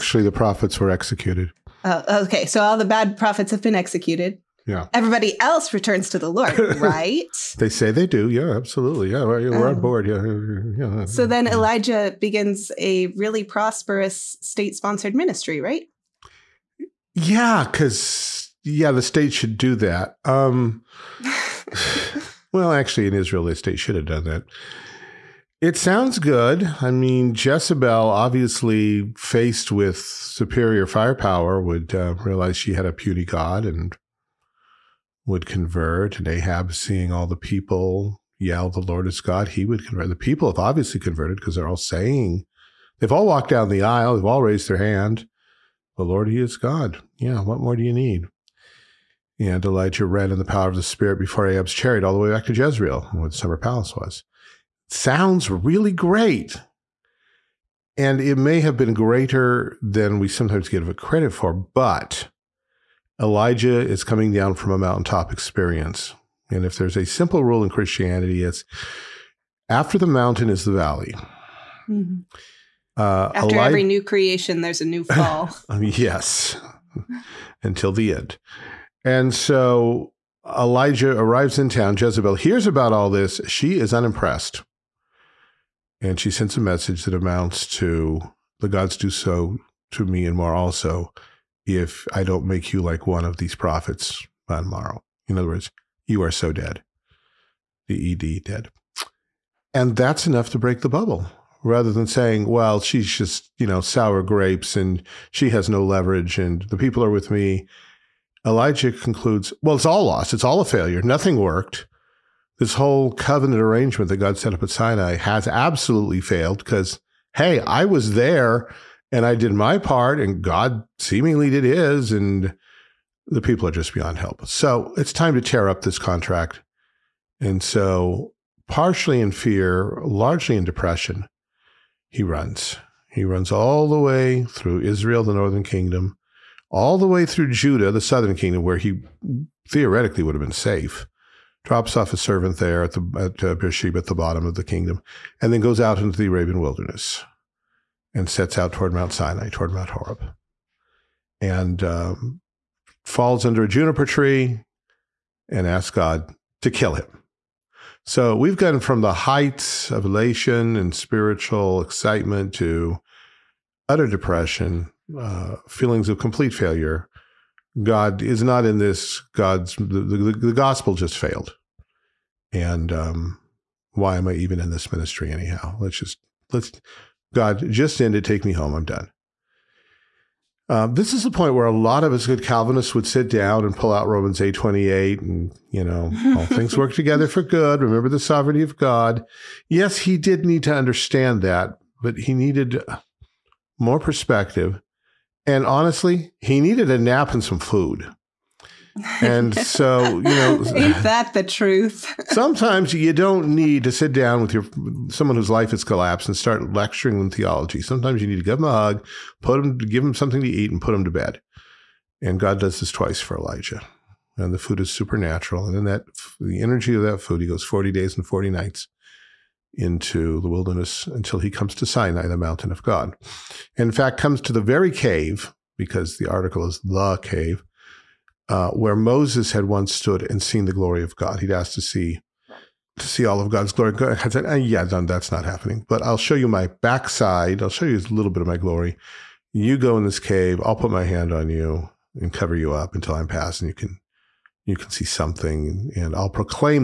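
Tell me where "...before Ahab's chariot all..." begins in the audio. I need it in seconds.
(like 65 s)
51 s.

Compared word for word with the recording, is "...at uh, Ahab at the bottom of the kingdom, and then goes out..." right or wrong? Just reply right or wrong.
wrong.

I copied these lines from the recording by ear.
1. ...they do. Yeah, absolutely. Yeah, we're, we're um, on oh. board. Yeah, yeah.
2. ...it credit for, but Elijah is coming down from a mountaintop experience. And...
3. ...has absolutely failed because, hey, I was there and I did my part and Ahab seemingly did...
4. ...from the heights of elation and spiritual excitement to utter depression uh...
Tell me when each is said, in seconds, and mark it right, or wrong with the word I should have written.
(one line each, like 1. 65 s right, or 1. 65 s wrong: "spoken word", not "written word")
1. 7 s right
2. 60 s right
3. 115 s wrong: "God", not "Ahab"
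4. 158 s right.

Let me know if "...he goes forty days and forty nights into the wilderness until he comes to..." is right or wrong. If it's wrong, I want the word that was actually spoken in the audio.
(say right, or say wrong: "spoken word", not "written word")
right.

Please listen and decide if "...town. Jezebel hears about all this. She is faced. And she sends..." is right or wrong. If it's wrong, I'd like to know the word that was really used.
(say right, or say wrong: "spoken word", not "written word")
wrong: "unimpressed", not "faced".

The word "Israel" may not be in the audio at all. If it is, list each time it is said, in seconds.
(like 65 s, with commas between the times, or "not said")
23 s, 134 s.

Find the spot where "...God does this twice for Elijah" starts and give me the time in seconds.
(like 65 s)
212 s.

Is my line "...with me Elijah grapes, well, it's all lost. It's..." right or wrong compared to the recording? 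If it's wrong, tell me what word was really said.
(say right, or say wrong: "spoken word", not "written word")
wrong: "concludes", not "grapes".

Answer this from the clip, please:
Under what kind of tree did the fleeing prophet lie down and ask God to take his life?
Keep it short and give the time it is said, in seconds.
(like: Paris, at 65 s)
juniper tree, at 153 s.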